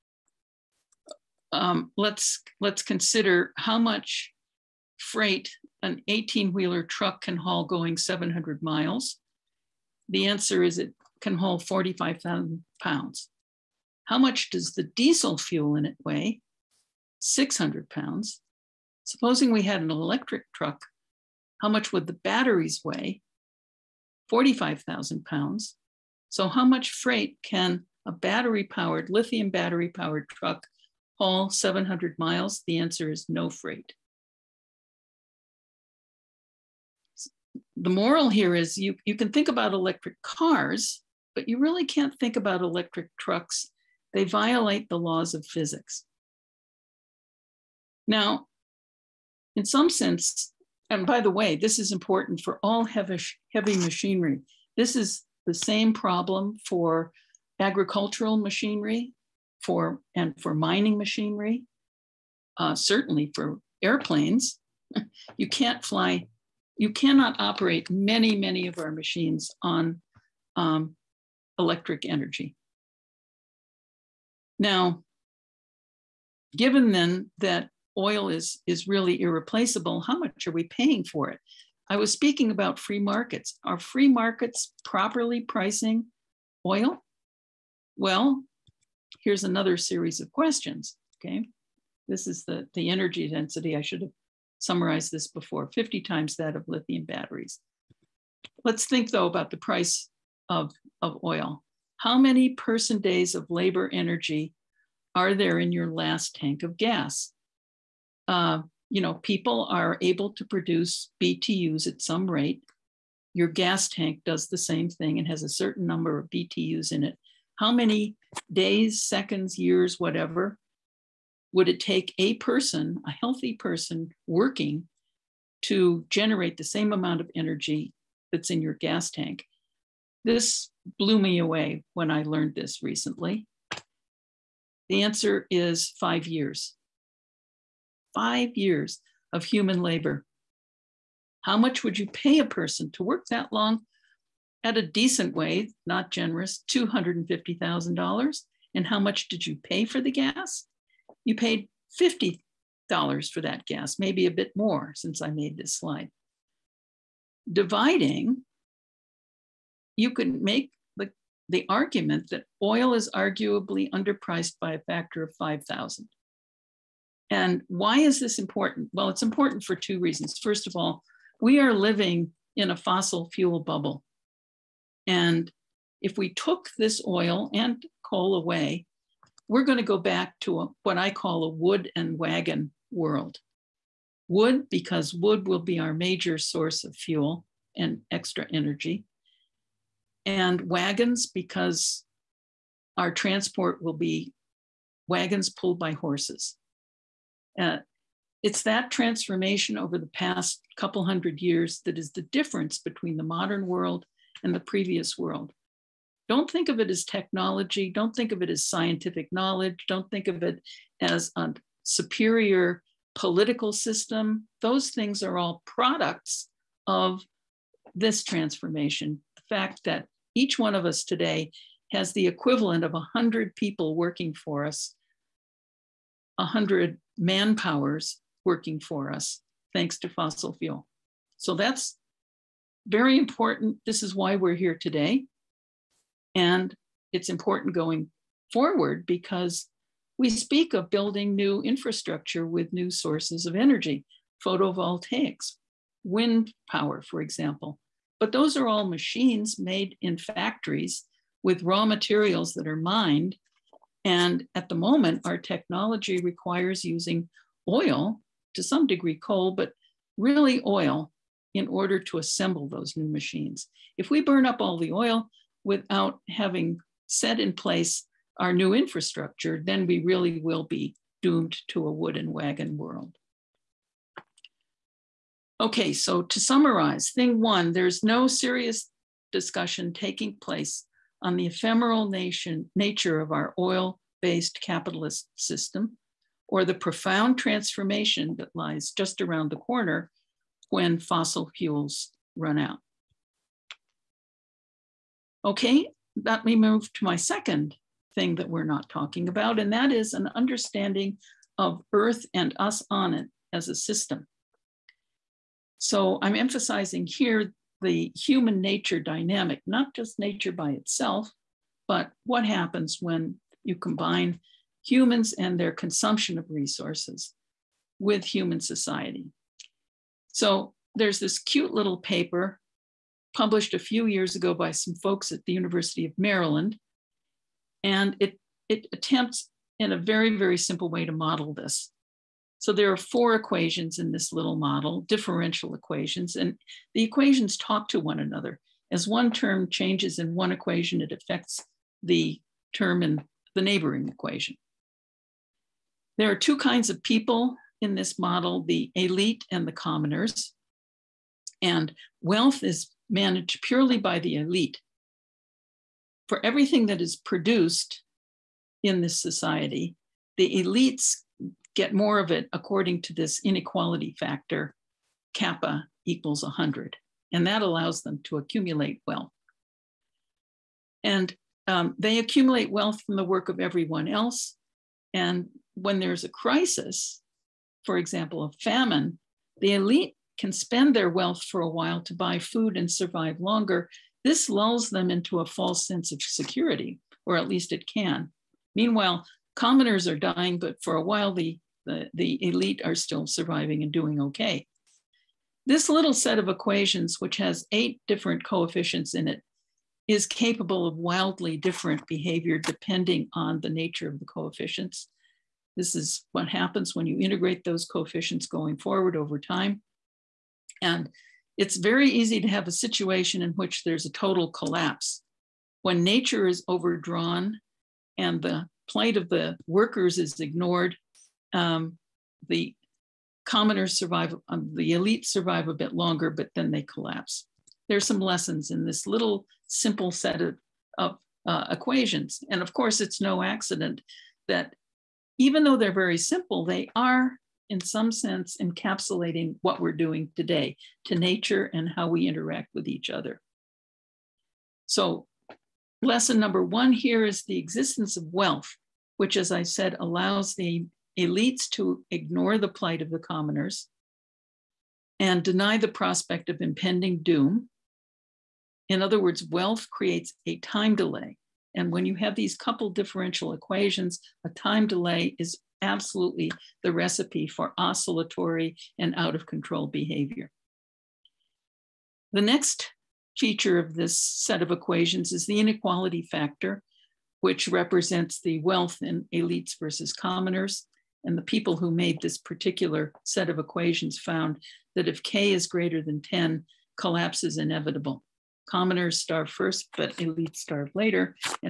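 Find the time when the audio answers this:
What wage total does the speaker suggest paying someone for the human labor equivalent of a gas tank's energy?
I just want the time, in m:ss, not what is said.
2:26.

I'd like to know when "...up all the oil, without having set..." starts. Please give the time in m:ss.
4:24.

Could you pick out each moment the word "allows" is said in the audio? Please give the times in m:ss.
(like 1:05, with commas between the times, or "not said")
6:07, 7:29.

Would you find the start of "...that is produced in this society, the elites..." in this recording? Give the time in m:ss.
5:56.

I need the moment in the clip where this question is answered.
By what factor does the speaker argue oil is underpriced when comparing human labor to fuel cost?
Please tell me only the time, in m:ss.
2:45.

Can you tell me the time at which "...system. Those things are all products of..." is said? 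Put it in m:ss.
3:33.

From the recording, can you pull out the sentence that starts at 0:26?
So, how much freight can a battery powered, lithium battery powered truck haul 700 miles?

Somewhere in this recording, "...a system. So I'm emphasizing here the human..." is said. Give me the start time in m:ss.
5:03.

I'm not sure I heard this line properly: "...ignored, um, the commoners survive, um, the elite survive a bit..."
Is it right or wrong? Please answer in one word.
right.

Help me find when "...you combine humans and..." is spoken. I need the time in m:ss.
5:13.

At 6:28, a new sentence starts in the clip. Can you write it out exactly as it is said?
Meanwhile, commoners are dying, but for a while the, the, the elite are still surviving and doing okay.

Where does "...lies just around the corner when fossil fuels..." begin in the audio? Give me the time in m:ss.
4:48.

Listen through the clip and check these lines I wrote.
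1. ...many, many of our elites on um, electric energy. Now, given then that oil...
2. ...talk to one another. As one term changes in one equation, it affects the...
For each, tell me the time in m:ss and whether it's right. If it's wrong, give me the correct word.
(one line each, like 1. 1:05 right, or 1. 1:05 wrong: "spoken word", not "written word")
1. 1:07 wrong: "machines", not "elites"
2. 5:37 right.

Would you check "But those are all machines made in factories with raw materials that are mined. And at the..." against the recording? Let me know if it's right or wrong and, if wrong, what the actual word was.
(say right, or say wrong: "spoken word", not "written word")
right.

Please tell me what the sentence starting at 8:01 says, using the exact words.
And the people who made this particular set of equations found that if k is greater than 10, collapse is inevitable.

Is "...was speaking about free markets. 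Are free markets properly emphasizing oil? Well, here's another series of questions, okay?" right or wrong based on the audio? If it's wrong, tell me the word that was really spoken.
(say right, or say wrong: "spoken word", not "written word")
wrong: "pricing", not "emphasizing".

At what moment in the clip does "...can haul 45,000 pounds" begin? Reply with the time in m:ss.
0:11.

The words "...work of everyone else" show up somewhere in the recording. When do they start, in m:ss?
6:13.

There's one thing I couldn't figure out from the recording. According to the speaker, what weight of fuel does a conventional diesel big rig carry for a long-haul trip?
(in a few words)
600 pounds.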